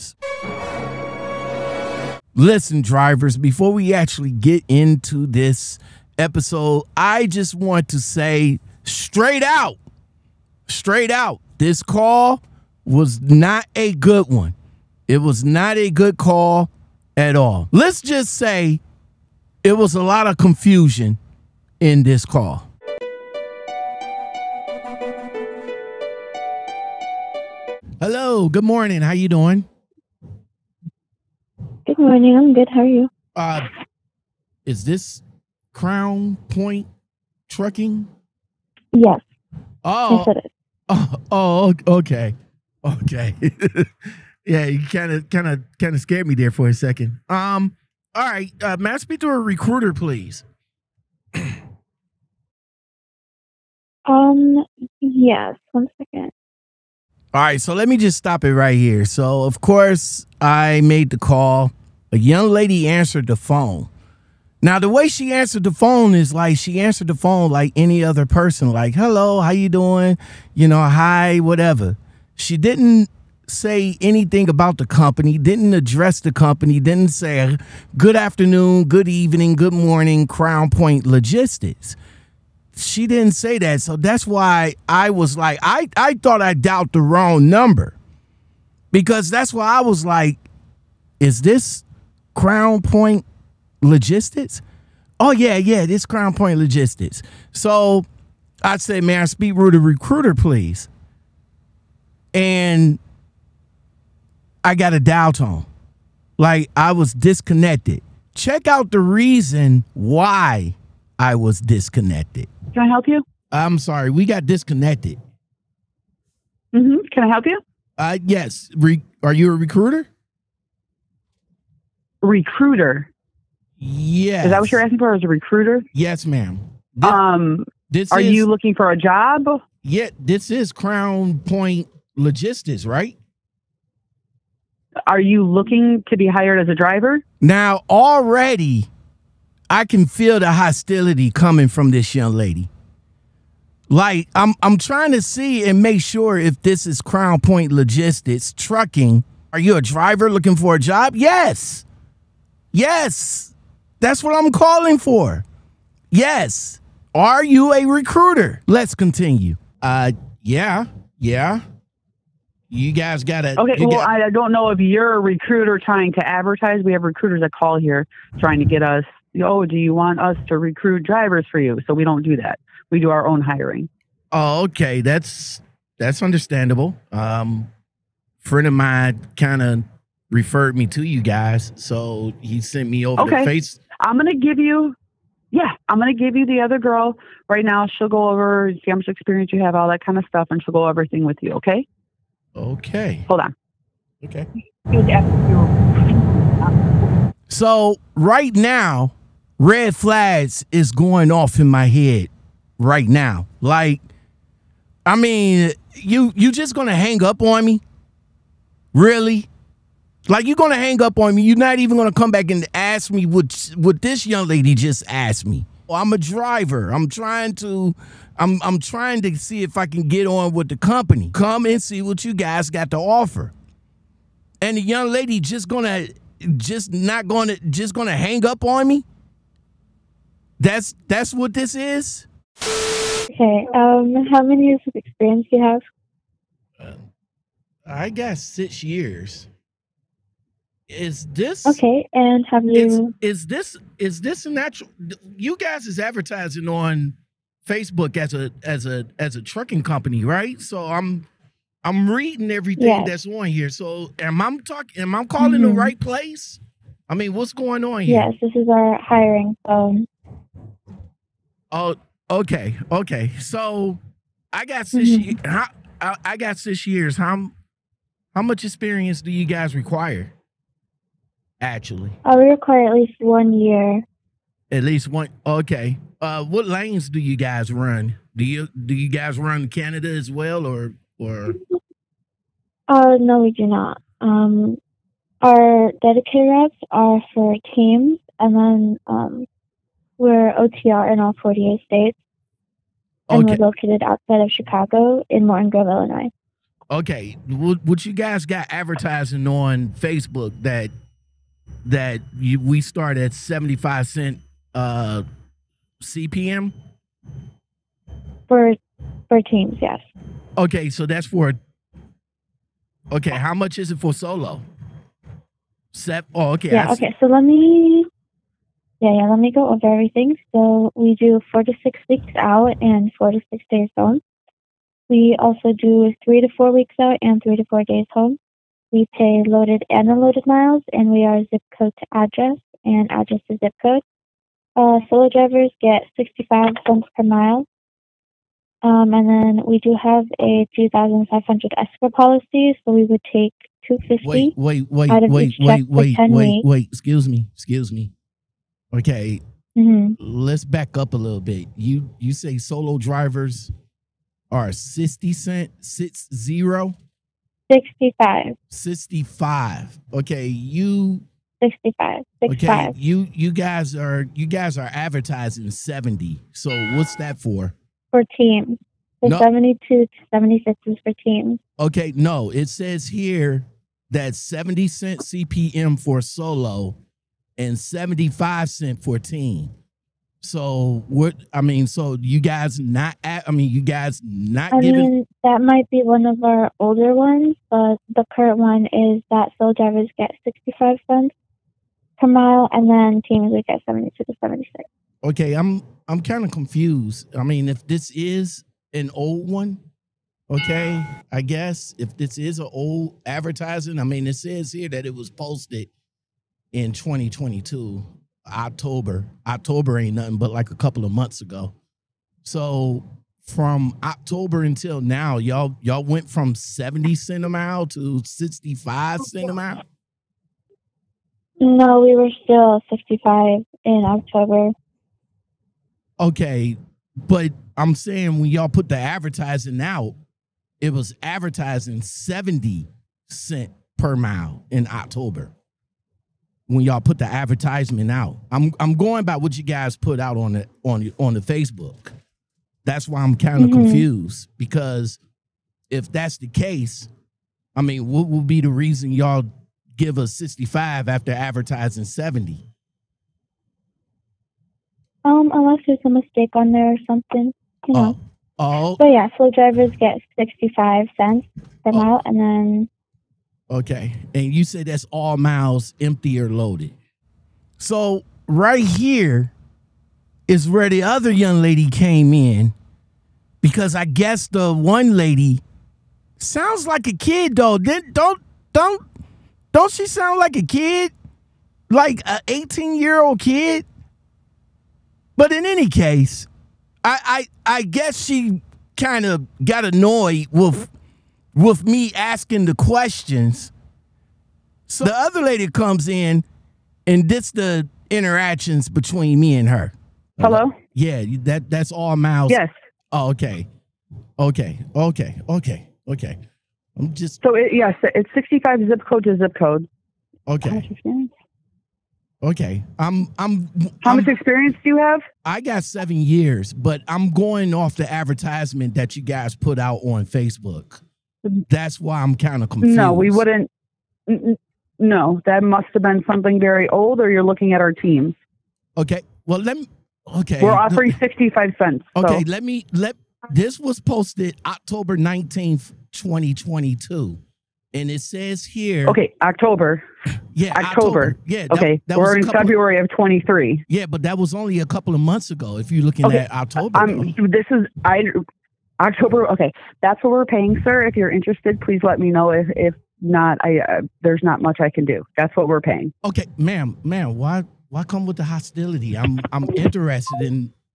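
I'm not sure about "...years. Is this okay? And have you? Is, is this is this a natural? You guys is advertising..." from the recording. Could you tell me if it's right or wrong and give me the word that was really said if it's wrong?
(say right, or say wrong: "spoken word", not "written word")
right.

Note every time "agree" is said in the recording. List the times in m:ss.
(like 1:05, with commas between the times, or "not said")
not said.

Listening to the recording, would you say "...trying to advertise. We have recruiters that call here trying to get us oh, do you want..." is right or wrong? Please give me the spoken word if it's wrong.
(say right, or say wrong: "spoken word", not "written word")
right.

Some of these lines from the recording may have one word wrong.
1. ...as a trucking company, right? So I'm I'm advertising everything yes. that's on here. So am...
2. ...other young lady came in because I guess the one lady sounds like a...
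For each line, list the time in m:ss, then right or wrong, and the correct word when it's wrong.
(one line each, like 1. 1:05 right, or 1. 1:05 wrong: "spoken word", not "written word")
1. 4:09 wrong: "reading", not "advertising"
2. 7:51 right.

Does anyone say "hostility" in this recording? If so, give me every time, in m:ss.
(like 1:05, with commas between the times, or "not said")
2:20, 9:18.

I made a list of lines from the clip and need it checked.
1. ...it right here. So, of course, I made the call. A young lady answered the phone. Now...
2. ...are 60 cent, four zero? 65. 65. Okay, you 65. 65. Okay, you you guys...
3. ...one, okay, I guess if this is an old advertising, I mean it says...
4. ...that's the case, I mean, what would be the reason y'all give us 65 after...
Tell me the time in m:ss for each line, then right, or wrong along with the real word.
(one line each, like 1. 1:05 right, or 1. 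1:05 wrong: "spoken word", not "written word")
1. 0:58 right
2. 5:54 wrong: "six", not "four"
3. 6:39 right
4. 7:26 right.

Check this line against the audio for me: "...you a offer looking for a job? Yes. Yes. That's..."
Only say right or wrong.
wrong.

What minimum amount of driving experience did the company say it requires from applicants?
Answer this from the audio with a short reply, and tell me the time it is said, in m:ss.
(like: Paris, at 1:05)
At least one year, at 4:32.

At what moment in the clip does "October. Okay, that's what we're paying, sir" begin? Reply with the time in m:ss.
9:08.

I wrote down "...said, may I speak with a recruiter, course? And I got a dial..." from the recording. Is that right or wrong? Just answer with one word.
wrong.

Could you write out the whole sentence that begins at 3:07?
She'll go over, see how much experience you have, all that kind of stuff, and she'll go everything with you.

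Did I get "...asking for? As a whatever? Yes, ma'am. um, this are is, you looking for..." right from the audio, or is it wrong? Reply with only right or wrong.
wrong.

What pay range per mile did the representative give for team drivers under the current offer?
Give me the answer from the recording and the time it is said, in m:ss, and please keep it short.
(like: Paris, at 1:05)
72 to 76 cents, at 6:33.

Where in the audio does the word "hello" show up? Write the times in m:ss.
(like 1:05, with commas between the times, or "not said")
0:27, 1:08, 8:20.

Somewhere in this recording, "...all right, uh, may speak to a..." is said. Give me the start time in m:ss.
0:48.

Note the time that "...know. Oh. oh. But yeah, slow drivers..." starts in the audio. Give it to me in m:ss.
7:37.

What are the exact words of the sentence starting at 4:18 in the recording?
Yes, this is our hiring phone.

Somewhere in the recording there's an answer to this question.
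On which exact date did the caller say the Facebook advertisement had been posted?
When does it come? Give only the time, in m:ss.
8:54.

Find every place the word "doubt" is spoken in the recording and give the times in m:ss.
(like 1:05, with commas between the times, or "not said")
1:26.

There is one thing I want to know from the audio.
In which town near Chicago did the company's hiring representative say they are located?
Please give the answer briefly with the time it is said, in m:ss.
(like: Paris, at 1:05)
Morton Grove, Illinois, at 4:55.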